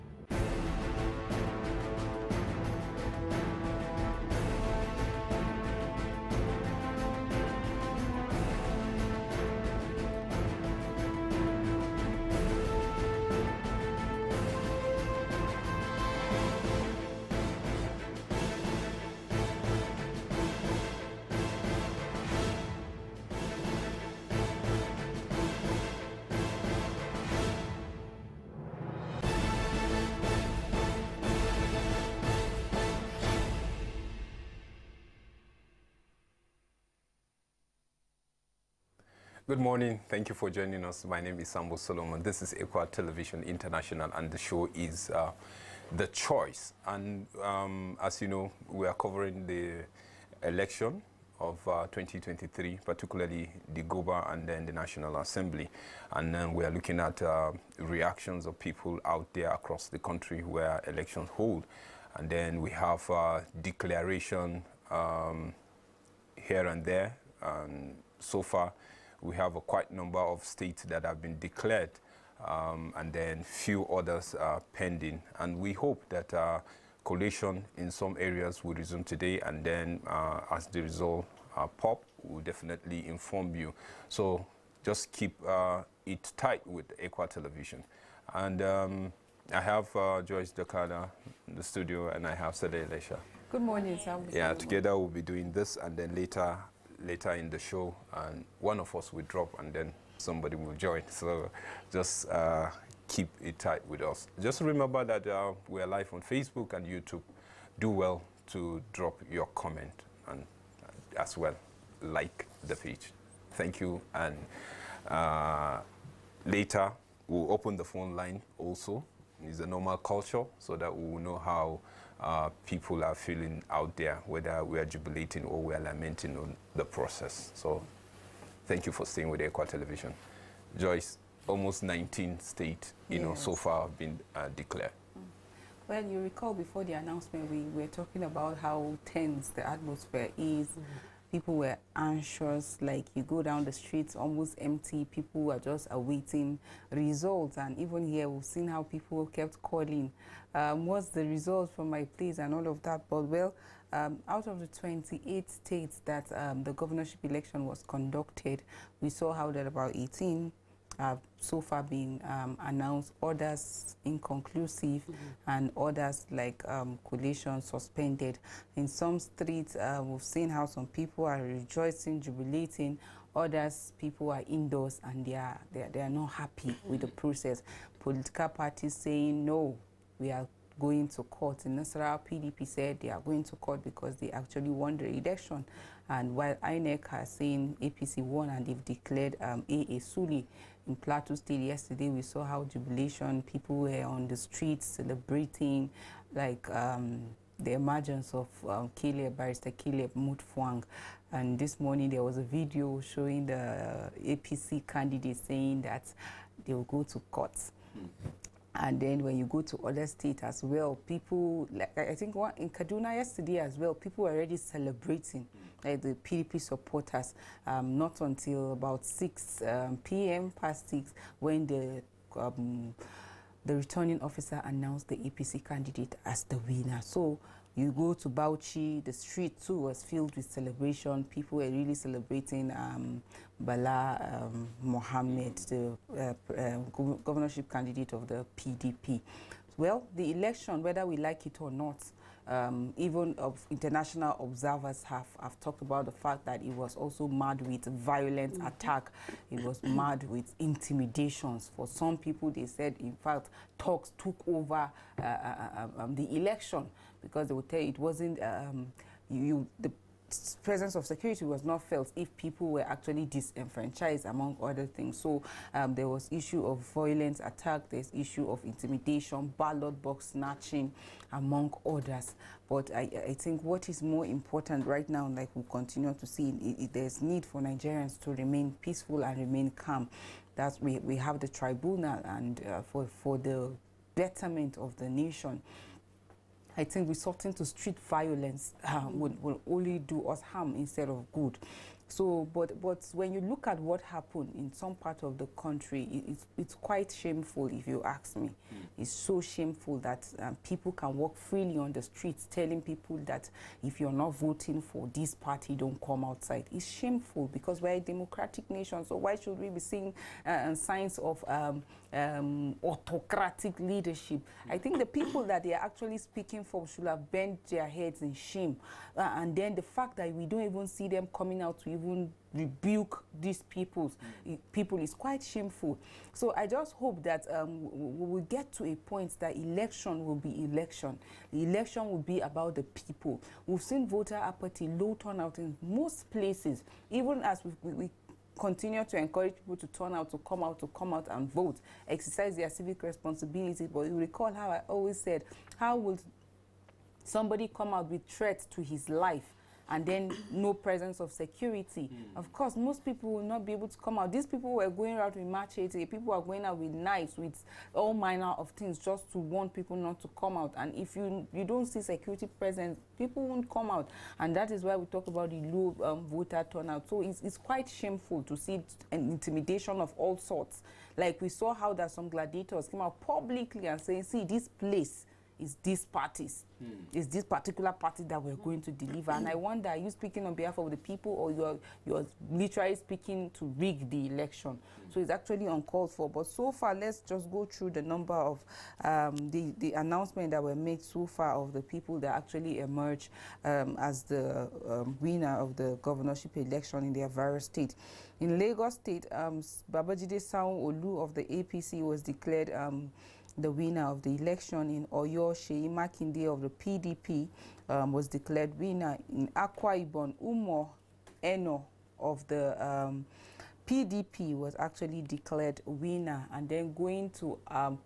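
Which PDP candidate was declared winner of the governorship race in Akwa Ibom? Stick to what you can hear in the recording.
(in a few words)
Umo Eno.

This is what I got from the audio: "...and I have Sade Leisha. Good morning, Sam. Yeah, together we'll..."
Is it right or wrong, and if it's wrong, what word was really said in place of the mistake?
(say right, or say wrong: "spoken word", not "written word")
right.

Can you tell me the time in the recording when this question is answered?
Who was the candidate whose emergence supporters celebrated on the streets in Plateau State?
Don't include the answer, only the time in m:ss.
3:19.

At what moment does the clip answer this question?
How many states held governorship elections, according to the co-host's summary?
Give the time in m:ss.
2:34.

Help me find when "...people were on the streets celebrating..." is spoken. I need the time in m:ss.
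3:13.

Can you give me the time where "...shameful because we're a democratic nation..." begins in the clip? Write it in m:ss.
5:06.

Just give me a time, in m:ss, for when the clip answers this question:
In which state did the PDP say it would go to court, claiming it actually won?
3:01.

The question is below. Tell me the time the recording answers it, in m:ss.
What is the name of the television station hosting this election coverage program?
0:42.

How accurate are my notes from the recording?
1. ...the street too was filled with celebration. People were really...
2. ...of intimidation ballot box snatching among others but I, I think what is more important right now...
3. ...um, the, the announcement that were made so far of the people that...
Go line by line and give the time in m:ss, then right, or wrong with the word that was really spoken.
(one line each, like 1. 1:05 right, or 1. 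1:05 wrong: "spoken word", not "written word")
1. 3:49 right
2. 4:28 right
3. 6:29 right.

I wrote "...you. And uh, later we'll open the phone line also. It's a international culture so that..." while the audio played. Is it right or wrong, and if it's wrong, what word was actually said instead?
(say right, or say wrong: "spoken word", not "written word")
wrong: "normal", not "international".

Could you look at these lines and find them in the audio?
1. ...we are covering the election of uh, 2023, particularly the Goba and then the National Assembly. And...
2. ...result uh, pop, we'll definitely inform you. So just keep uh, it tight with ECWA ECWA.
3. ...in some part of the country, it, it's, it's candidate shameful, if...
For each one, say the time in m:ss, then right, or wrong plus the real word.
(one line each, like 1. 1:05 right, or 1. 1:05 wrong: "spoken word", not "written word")
1. 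0:48 right
2. 1:20 wrong: "Television", not "ECWA"
3. 4:54 wrong: "quite", not "candidate".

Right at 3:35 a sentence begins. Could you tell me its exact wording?
like the PDP supporters, um, not until about 6 um, p.m.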